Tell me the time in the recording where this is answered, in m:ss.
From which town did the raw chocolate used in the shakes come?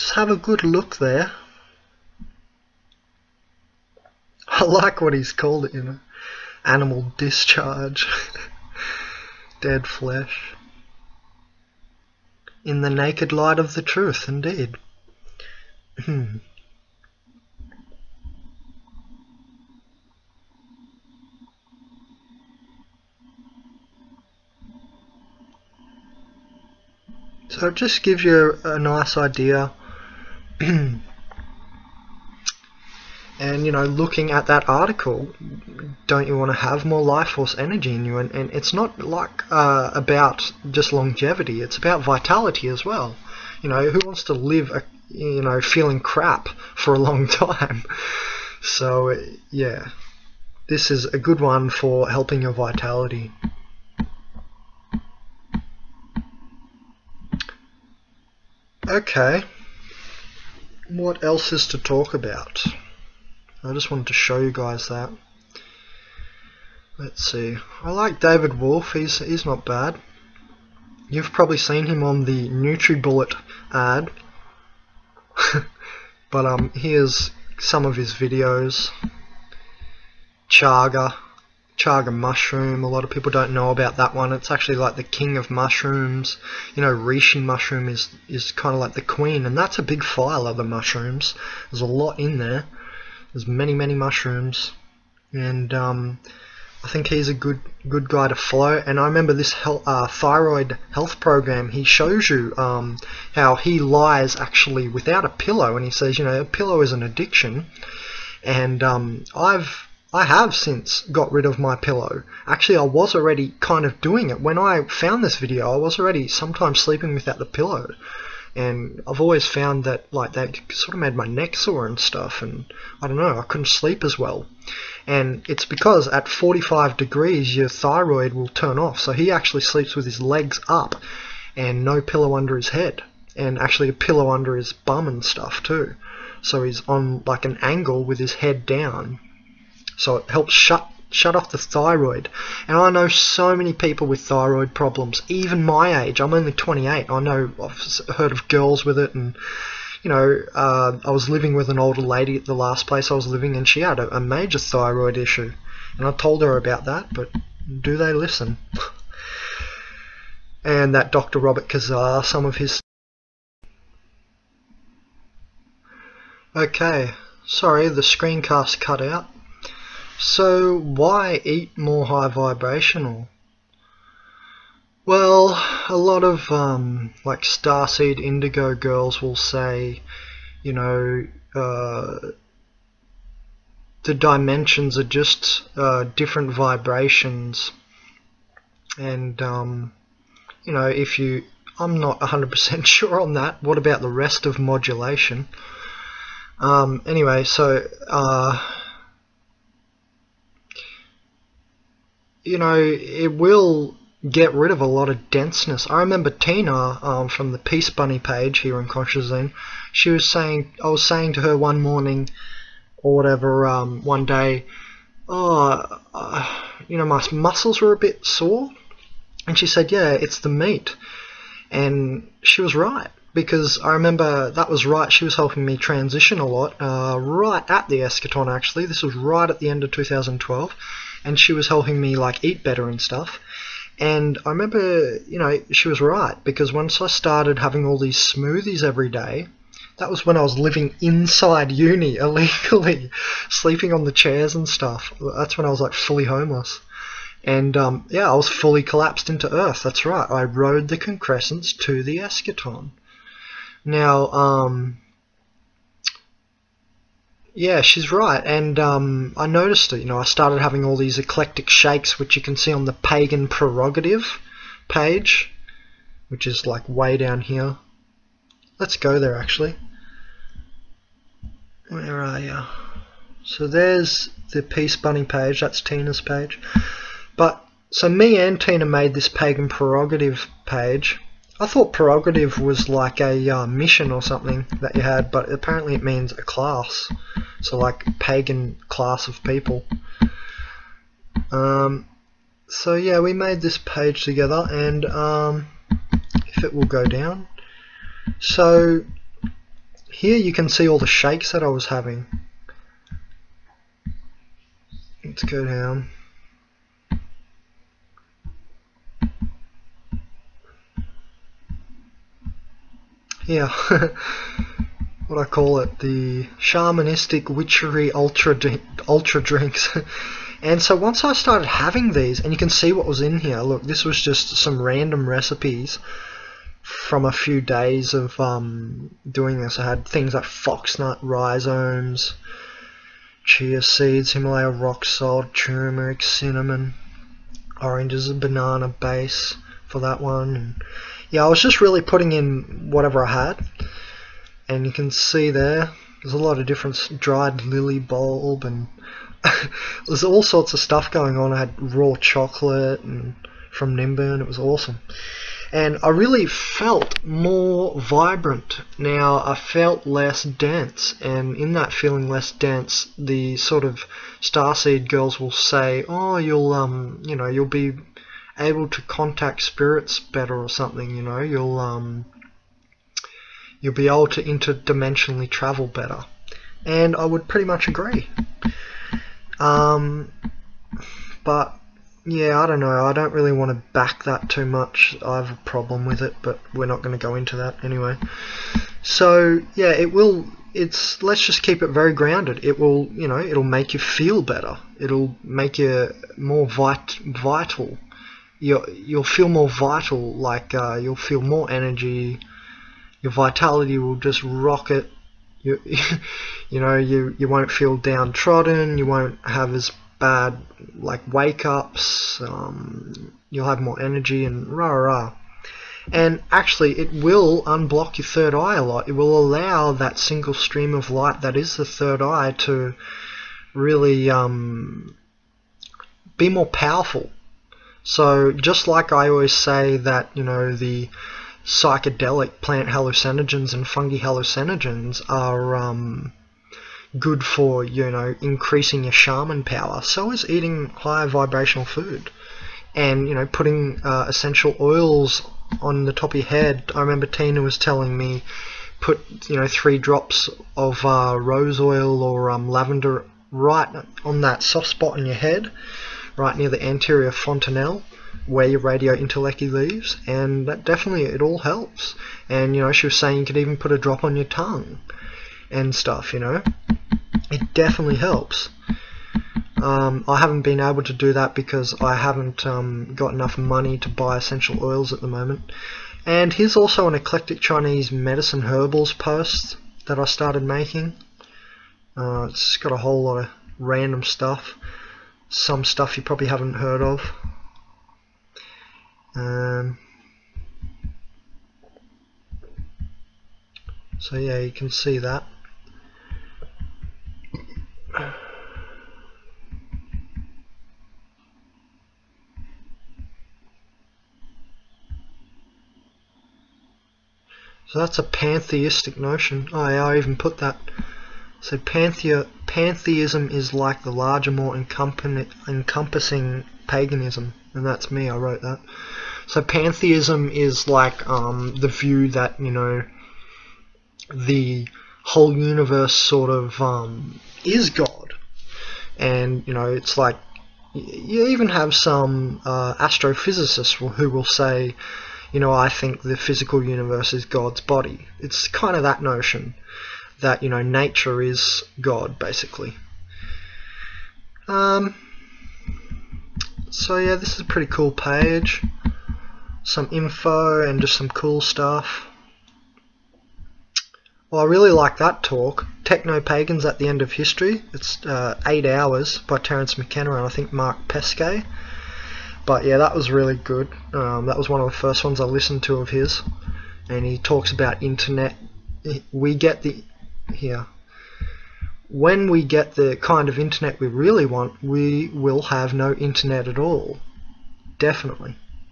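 5:53.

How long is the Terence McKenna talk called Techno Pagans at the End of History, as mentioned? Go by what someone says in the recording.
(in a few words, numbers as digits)
Eight hours.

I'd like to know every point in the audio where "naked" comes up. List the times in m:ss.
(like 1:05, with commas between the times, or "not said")
0:12.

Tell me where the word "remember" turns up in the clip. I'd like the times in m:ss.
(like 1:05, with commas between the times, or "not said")
1:39, 3:26, 3:43, 3:54, 7:27.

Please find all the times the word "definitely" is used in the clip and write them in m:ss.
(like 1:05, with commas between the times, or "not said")
7:40, 7:47, 9:37.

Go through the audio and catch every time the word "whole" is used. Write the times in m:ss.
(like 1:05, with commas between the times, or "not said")
8:02, 8:45.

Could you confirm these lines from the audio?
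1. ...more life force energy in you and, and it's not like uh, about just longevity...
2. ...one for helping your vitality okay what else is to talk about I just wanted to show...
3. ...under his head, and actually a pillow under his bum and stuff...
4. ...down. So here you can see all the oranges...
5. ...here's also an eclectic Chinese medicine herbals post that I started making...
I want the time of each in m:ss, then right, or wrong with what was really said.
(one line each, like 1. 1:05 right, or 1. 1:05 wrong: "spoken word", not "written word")
1. 0:36 right
2. 0:51 right
3. 2:12 right
4. 4:57 wrong: "shakes", not "oranges"
5. 7:56 right.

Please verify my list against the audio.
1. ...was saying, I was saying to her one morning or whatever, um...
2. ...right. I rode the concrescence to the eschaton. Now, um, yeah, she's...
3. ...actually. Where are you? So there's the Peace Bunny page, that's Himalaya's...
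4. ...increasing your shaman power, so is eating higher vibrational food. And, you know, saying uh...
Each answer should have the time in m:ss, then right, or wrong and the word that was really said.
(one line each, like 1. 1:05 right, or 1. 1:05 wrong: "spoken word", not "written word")
1. 3:30 right
2. 4:10 right
3. 4:29 wrong: "Tina", not "Himalaya"
4. 7:18 wrong: "putting", not "saying".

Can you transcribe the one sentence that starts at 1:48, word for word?
And um, I've I have since got rid of my pillow.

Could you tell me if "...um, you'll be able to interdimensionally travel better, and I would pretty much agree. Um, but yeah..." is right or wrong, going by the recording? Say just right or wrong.
right.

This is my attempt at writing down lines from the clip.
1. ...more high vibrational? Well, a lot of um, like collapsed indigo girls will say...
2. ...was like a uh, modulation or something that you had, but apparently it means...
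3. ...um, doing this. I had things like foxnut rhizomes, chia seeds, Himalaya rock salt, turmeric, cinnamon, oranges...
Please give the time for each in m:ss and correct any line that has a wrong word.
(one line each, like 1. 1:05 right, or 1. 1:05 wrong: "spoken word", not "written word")
1. 2:51 wrong: "starseed", not "collapsed"
2. 4:42 wrong: "mission", not "modulation"
3. 5:28 right.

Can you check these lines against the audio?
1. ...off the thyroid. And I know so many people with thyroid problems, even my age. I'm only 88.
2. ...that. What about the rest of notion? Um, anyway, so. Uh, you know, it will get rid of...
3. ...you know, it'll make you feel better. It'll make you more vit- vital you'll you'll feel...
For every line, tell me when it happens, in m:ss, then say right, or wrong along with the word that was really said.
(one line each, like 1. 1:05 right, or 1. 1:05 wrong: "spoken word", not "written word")
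1. 2:21 wrong: "28", not "88"
2. 3:13 wrong: "modulation", not "notion"
3. 6:33 right.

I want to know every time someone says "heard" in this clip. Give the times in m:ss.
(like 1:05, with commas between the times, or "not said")
2:28, 8:06.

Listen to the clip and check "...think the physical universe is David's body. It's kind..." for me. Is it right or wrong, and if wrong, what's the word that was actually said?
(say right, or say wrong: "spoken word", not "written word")
wrong: "God", not "David".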